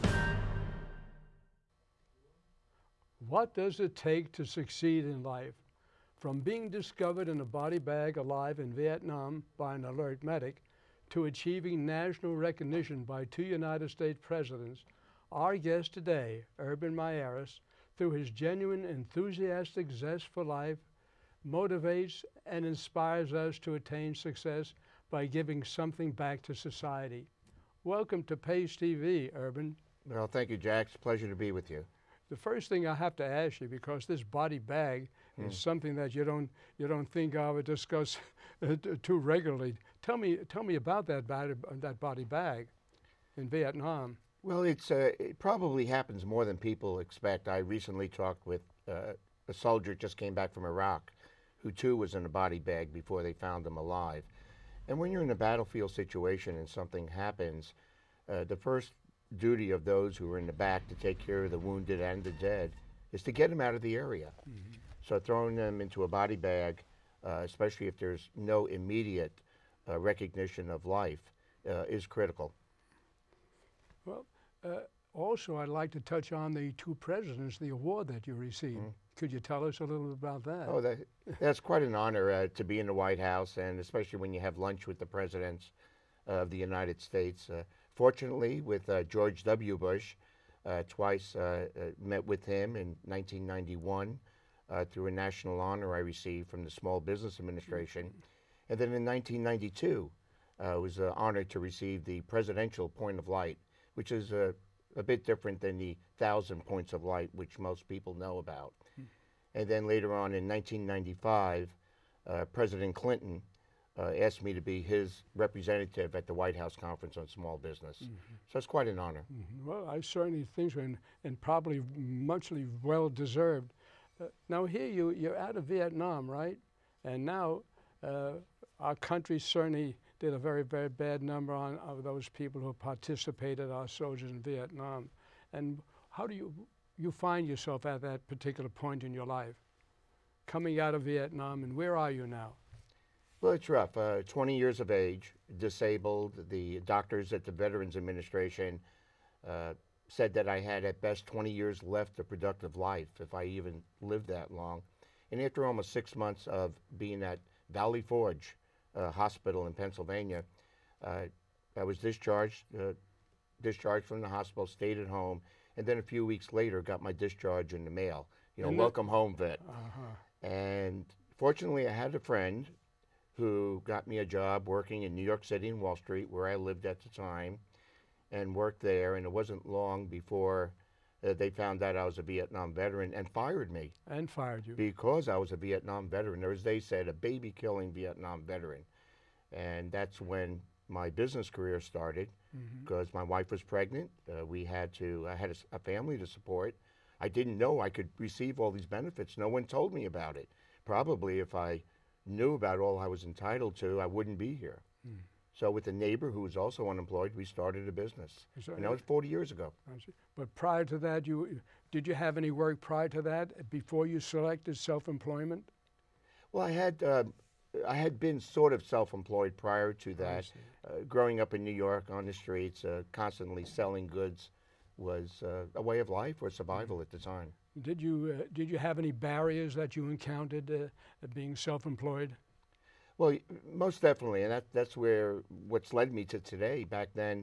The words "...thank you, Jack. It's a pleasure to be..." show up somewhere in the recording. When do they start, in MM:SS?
00:30.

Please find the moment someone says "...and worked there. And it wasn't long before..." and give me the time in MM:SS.
02:58.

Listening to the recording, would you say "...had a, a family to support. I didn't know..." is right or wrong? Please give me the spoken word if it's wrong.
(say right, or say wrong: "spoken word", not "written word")
right.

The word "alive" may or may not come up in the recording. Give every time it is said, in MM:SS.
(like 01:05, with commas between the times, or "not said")
00:08, 00:53.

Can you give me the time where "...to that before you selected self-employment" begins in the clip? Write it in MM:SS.
03:33.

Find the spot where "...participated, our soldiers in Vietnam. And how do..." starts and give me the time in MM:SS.
02:12.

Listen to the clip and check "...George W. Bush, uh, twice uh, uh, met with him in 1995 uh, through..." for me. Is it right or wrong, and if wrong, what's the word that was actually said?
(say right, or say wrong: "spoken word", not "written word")
wrong: "1991", not "1995".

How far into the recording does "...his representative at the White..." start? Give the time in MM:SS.
01:54.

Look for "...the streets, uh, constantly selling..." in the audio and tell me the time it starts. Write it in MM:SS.
03:42.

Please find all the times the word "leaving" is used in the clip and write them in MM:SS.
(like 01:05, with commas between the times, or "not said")
not said.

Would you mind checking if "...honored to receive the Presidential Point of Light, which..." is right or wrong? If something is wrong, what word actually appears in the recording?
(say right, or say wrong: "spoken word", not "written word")
right.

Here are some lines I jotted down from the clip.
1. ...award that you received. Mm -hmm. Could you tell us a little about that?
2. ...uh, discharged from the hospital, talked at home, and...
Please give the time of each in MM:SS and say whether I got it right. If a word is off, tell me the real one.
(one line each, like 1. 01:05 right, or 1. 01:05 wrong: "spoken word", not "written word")
1. 01:17 right
2. 02:42 wrong: "stayed", not "talked".